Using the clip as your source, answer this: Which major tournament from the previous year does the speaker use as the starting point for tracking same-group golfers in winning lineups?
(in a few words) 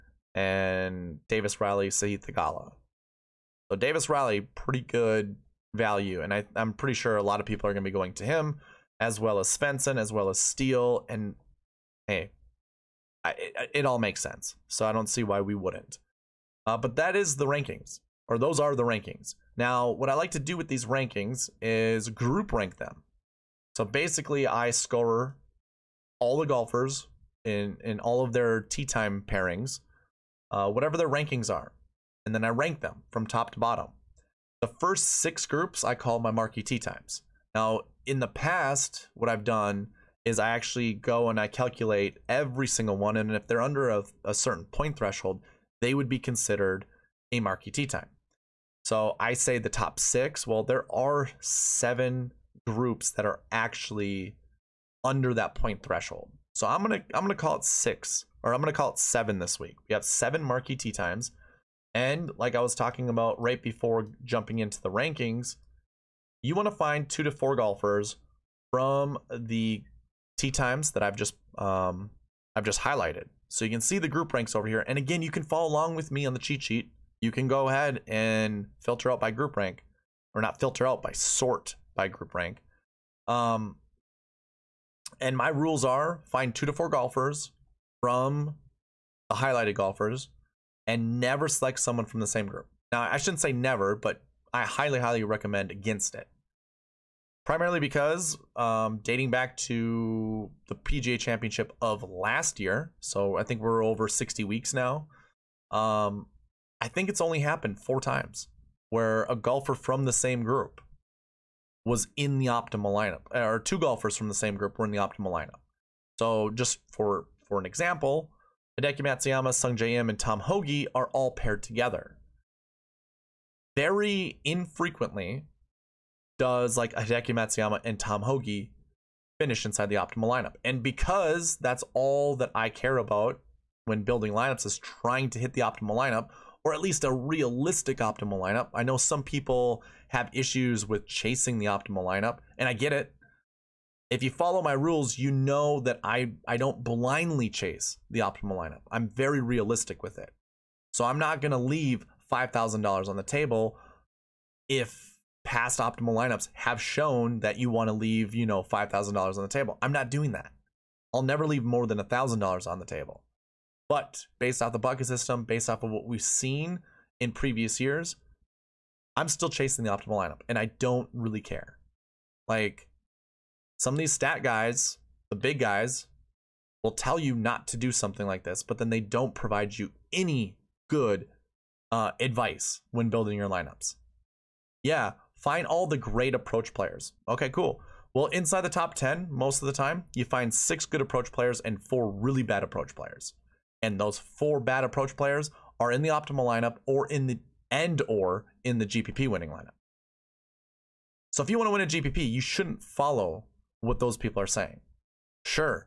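PGA Championship.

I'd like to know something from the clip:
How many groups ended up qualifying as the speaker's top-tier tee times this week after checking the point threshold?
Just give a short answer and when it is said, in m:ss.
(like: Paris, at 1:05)
7, at 0:59.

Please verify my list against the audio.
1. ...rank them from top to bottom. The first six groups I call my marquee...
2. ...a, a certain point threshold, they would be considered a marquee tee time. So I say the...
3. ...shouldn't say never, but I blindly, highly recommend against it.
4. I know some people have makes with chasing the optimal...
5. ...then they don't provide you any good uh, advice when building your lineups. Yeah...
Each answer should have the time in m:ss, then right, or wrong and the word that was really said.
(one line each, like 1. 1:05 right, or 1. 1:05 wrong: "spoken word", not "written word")
1. 0:32 right
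2. 0:43 right
3. 1:33 wrong: "highly", not "blindly"
4. 2:18 wrong: "issues", not "makes"
5. 2:58 right.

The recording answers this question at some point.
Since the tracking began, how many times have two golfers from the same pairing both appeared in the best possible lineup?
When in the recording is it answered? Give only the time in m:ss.
1:47.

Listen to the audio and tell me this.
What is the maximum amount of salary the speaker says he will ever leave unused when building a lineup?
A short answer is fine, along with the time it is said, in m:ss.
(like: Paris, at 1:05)
$1,000, at 2:41.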